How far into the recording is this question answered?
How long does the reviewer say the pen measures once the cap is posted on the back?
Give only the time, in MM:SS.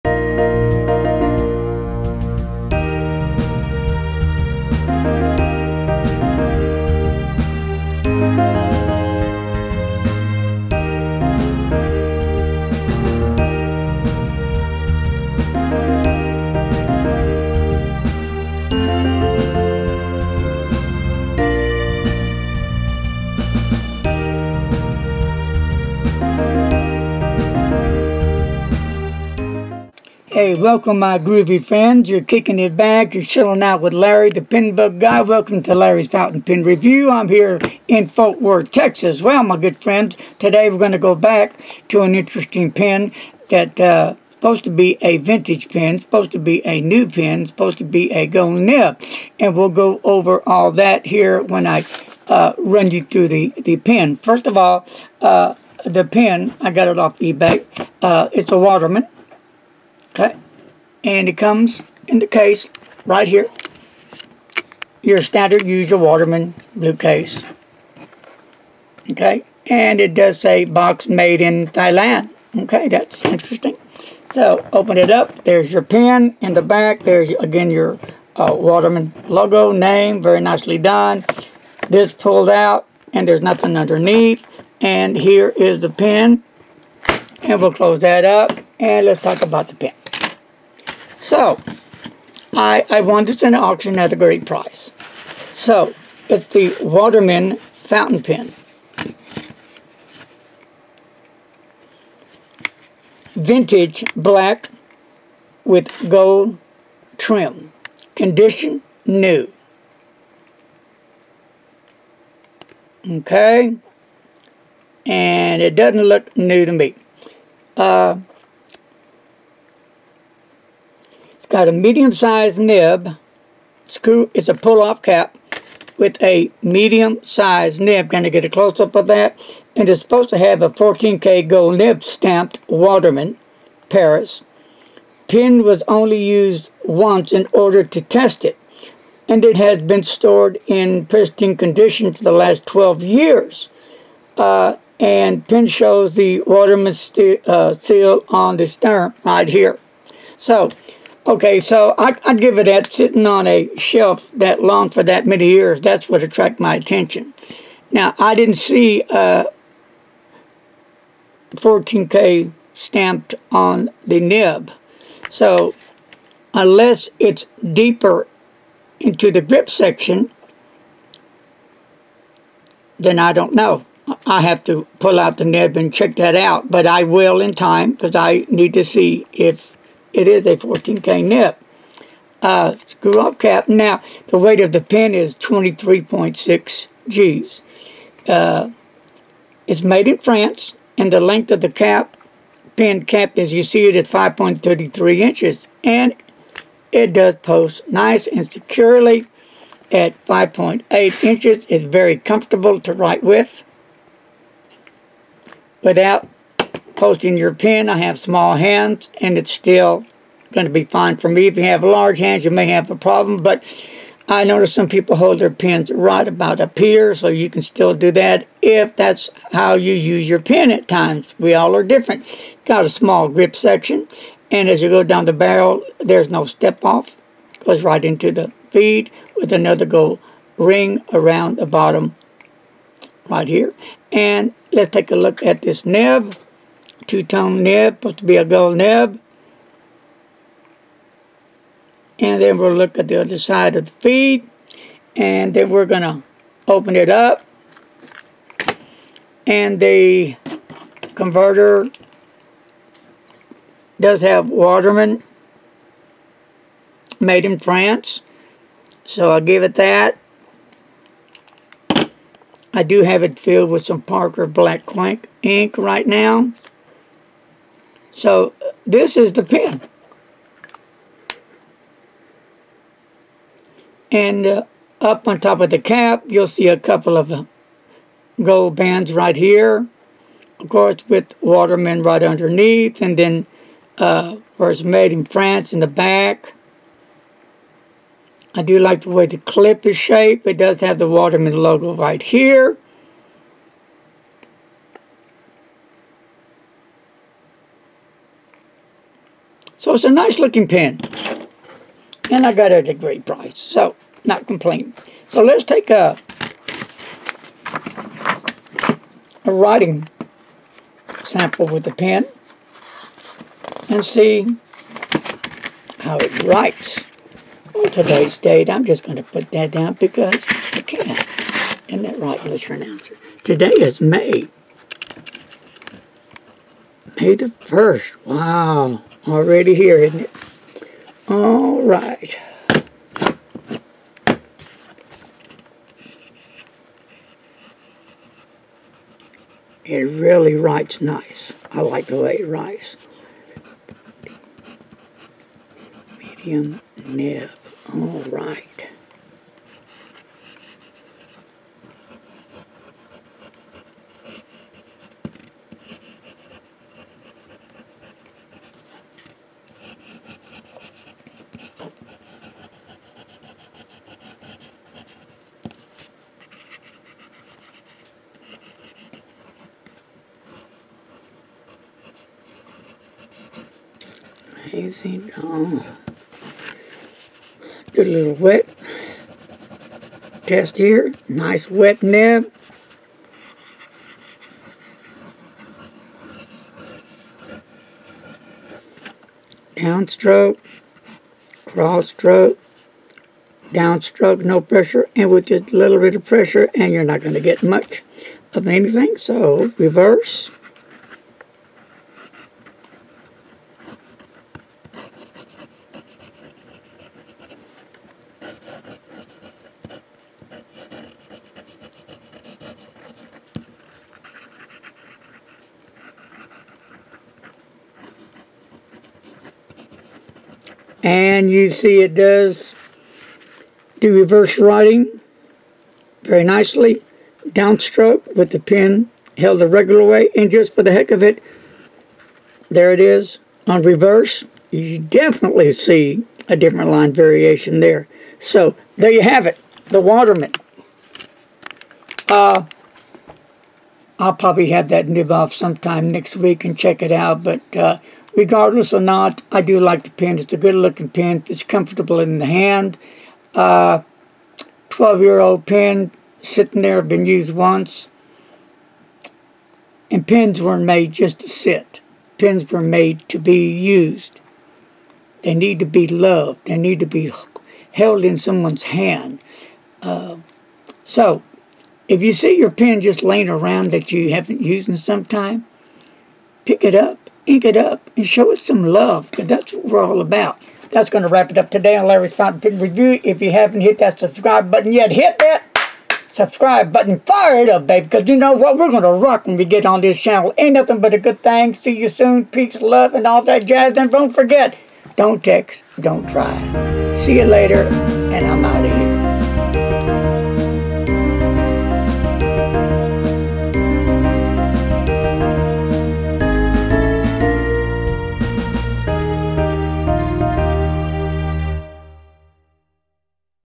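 03:20.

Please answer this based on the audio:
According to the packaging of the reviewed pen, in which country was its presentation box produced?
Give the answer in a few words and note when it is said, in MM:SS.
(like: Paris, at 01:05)
Thailand, at 01:11.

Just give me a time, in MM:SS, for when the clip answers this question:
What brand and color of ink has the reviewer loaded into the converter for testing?
04:24.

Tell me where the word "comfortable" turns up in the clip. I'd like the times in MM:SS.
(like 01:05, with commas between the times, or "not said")
03:22, 07:31.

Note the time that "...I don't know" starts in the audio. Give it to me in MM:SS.
02:53.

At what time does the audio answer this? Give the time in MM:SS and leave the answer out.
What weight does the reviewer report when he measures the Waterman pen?
03:05.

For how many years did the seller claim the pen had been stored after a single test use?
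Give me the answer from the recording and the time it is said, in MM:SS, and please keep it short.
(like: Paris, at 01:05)
12, at 02:22.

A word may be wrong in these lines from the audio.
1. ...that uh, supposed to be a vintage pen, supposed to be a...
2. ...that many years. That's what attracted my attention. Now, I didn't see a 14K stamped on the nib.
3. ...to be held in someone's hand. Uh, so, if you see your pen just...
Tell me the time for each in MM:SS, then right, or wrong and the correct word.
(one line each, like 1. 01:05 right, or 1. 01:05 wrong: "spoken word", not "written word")
1. 00:43 right
2. 02:35 right
3. 07:47 right.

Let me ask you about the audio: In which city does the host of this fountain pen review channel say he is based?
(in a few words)
Fort Worth, Texas.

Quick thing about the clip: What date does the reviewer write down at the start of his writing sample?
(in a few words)
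May 1st.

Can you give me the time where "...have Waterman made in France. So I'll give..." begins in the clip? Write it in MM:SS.
04:14.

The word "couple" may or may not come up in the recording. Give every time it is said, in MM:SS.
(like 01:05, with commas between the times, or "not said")
04:36.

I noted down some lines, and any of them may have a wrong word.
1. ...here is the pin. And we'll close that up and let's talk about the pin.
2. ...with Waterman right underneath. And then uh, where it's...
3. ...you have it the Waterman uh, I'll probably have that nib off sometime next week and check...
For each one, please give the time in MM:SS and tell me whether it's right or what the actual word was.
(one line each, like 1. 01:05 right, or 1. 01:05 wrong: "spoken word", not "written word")
1. 01:25 right
2. 04:41 right
3. 07:19 right.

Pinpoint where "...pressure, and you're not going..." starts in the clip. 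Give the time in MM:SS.
06:36.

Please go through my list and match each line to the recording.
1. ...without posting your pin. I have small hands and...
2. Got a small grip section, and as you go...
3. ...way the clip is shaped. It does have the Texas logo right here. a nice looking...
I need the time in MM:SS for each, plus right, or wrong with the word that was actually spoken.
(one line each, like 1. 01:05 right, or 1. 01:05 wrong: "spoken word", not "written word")
1. 03:25 right
2. 03:42 right
3. 04:49 wrong: "Waterman", not "Texas".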